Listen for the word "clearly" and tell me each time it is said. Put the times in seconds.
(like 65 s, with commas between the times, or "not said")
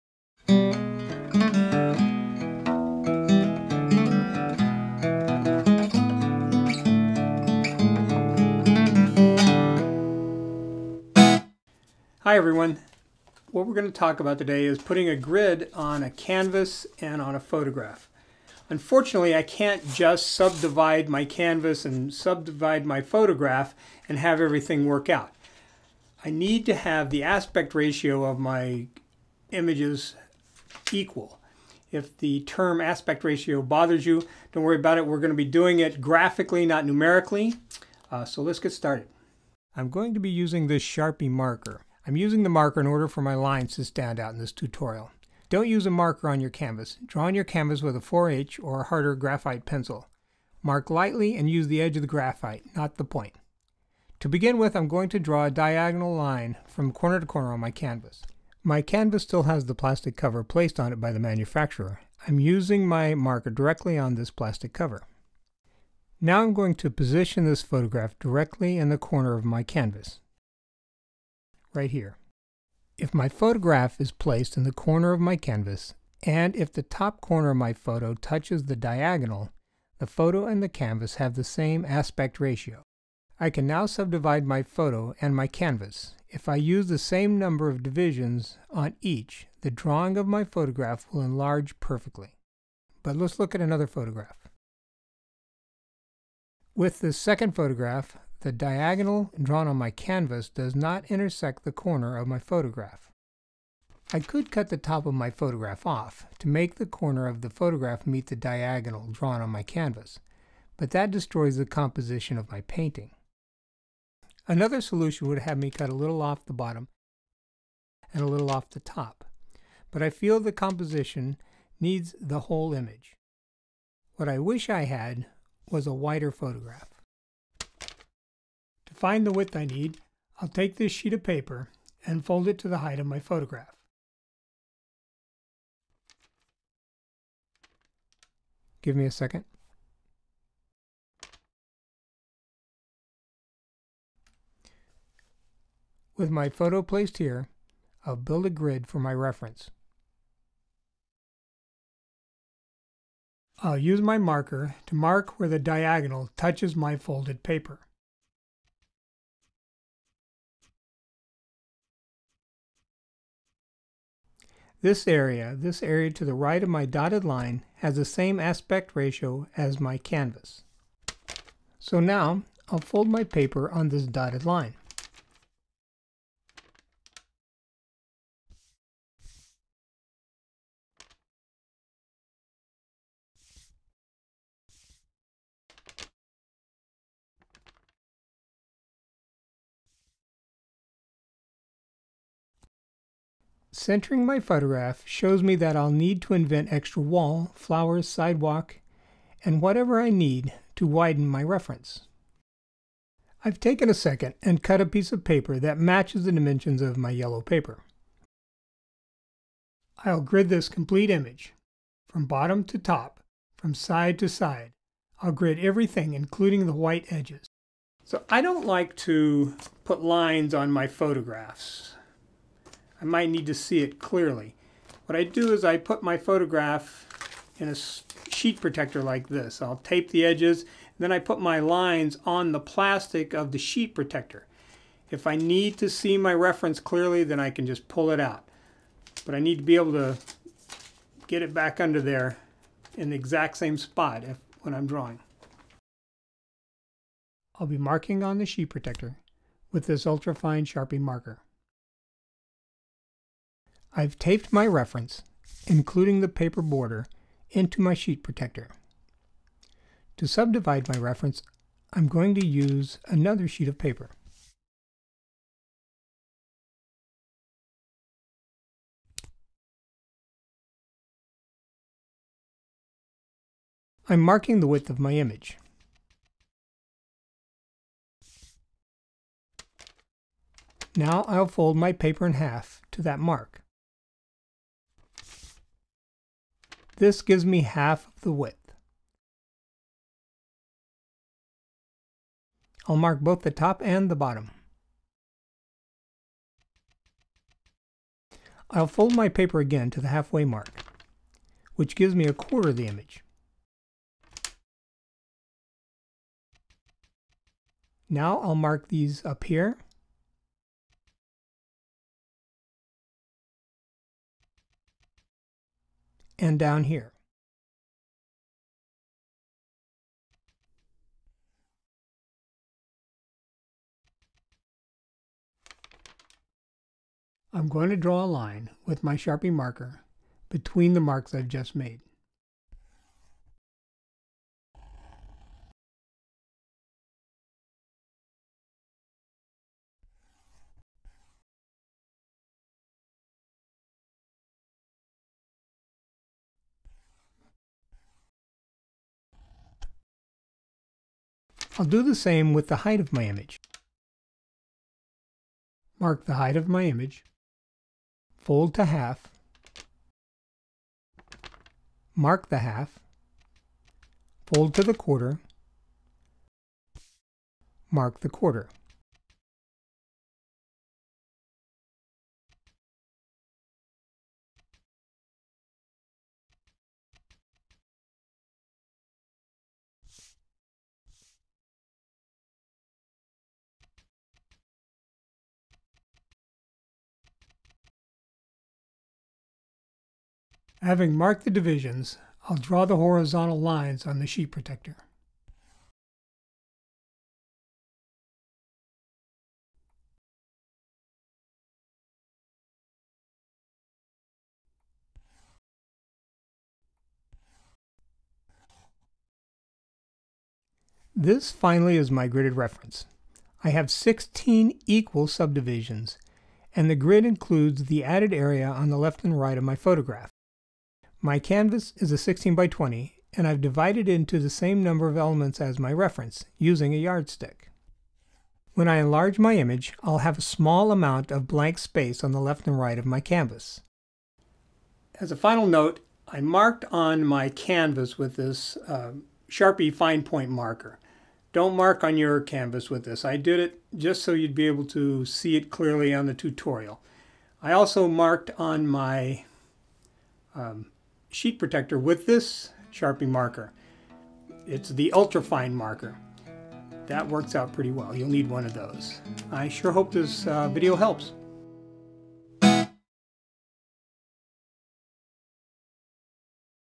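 223 s, 236 s, 445 s.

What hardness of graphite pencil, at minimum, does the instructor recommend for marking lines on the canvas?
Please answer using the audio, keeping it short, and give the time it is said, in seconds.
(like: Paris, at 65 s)
4H, at 47 s.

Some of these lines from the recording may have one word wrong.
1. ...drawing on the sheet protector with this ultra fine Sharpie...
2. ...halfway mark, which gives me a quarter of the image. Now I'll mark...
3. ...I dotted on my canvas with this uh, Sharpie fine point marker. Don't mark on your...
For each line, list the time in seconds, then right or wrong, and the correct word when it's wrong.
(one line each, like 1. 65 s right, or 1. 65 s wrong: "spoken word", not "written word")
1. 247 s wrong: "marking", not "drawing"
2. 300 s right
3. 436 s wrong: "marked", not "dotted".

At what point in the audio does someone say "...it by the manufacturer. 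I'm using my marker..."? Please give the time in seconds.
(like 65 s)
60 s.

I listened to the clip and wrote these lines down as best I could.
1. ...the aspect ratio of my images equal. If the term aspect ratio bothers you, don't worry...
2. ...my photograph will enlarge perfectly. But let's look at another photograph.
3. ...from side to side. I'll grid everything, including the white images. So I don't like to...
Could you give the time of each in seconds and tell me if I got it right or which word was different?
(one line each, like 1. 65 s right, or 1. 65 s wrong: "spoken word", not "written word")
1. 27 s right
2. 90 s right
3. 213 s wrong: "edges", not "images".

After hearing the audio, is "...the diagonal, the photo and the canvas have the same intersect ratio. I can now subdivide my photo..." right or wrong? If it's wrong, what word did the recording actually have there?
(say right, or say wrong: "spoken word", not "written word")
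wrong: "aspect", not "intersect".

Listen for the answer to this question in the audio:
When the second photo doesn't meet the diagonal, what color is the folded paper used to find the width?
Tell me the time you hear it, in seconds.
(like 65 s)
207 s.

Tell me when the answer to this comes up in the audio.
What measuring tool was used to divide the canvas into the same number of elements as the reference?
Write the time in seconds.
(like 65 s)
426 s.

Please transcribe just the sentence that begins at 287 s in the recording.
This gives me half of the width.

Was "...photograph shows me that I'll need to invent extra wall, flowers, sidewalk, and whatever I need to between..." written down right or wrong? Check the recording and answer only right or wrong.
wrong.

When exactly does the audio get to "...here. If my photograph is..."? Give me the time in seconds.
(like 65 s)
71 s.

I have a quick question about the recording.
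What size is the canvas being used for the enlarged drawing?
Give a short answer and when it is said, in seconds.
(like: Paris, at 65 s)
16 by 20, at 422 s.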